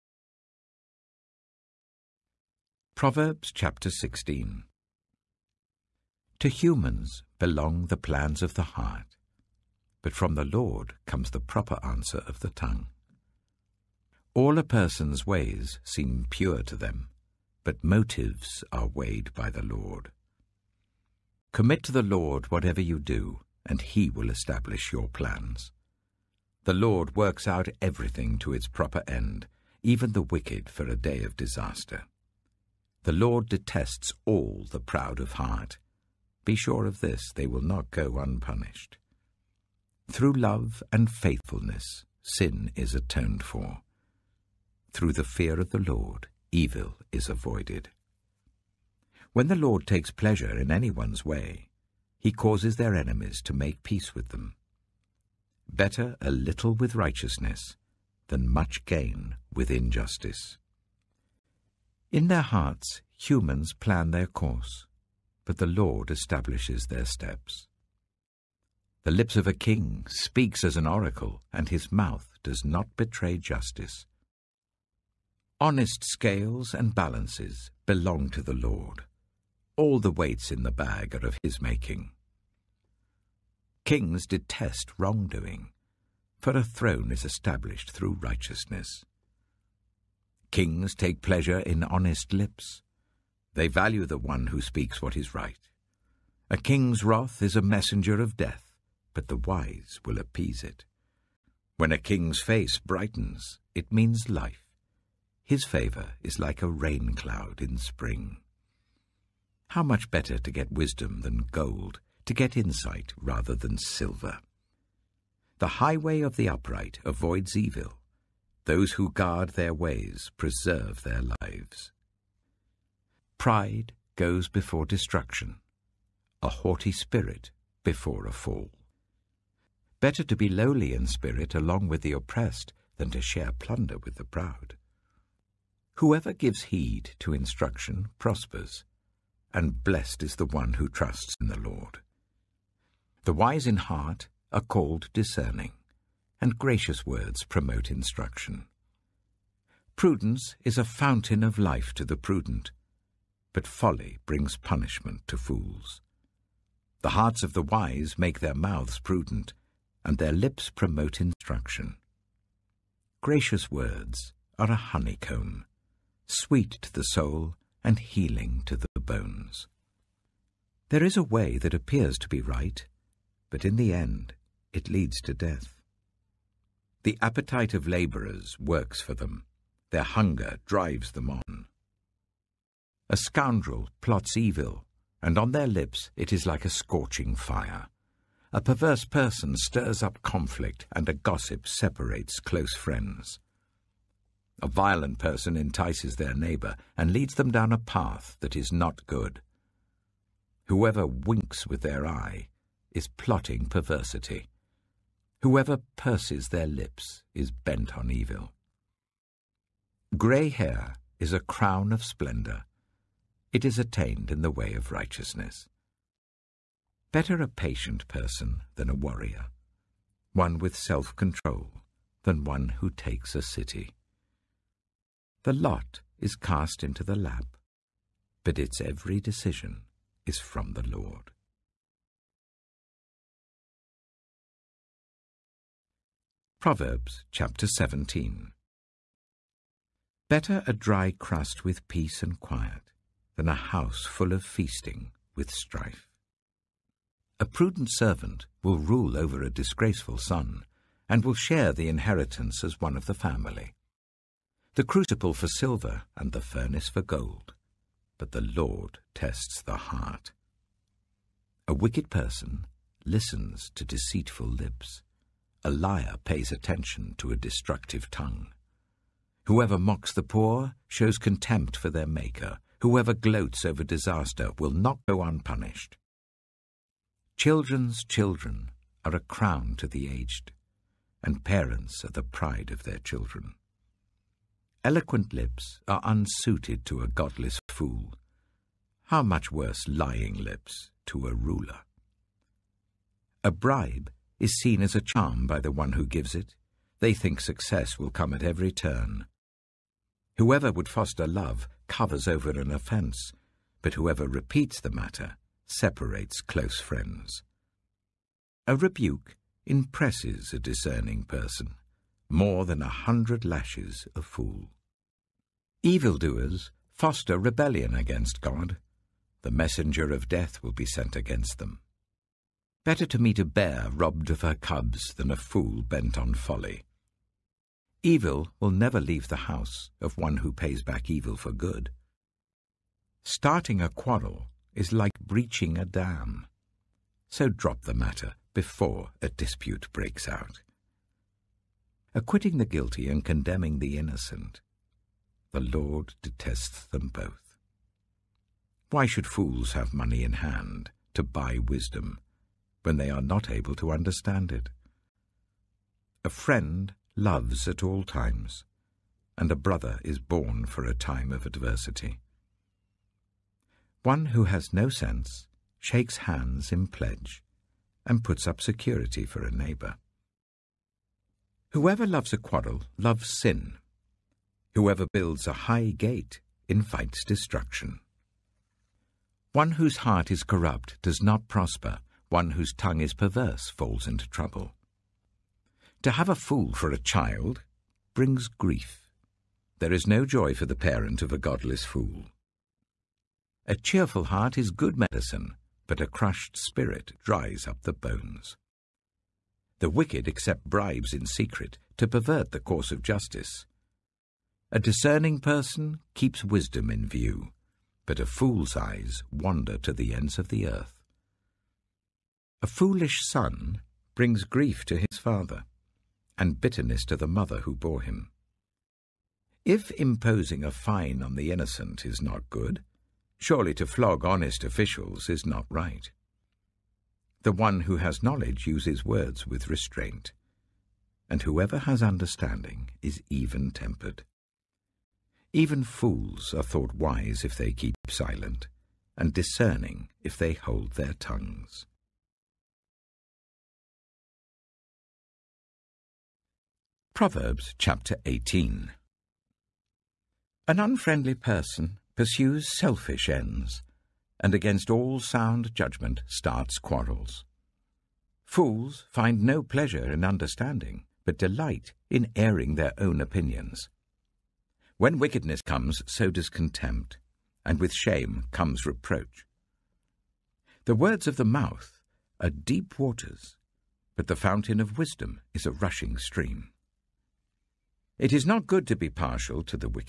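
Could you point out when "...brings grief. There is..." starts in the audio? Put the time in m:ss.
6:28.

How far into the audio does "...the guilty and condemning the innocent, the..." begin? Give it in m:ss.
5:42.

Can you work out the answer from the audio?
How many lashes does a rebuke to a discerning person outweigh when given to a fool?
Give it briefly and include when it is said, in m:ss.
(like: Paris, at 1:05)
100, at 5:12.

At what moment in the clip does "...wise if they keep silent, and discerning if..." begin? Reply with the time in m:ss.
7:16.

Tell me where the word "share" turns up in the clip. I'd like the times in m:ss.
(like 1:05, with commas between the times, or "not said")
2:13, 4:11.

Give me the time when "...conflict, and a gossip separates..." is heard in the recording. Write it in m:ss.
3:10.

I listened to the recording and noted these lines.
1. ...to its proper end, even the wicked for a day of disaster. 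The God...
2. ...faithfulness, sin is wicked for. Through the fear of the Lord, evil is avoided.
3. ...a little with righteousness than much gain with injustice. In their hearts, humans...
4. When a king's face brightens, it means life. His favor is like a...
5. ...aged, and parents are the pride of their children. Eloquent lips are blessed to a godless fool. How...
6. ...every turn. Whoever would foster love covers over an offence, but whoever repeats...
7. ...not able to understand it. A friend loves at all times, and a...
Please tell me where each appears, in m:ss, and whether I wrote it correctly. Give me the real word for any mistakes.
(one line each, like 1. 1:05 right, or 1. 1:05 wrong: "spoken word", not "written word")
1. 0:28 wrong: "Lord", not "God"
2. 0:41 wrong: "atoned", not "wicked"
3. 0:56 right
4. 1:41 right
5. 4:40 wrong: "unsuited", not "blessed"
6. 4:58 right
7. 5:53 right.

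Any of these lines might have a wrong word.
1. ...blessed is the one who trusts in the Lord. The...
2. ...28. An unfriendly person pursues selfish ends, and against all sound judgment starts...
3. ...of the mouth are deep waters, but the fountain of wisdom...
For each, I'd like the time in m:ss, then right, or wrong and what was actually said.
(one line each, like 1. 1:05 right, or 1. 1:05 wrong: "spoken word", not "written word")
1. 2:19 right
2. 7:28 wrong: "18", not "28"
3. 7:51 right.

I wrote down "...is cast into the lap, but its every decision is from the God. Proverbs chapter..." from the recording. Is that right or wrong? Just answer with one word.
wrong.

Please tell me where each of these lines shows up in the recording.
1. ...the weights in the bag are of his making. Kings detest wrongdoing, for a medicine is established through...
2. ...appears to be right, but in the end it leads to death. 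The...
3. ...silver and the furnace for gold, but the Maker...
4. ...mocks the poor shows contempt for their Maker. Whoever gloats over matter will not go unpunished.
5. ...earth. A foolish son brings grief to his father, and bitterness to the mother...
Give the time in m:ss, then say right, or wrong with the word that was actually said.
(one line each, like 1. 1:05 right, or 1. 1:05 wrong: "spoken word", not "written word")
1. 1:19 wrong: "throne", not "medicine"
2. 2:51 right
3. 4:15 wrong: "Lord", not "Maker"
4. 4:29 wrong: "disaster", not "matter"
5. 6:50 right.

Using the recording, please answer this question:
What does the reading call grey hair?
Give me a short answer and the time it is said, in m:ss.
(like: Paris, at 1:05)
A crown of splendour, at 3:31.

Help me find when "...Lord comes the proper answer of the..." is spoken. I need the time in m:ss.
0:10.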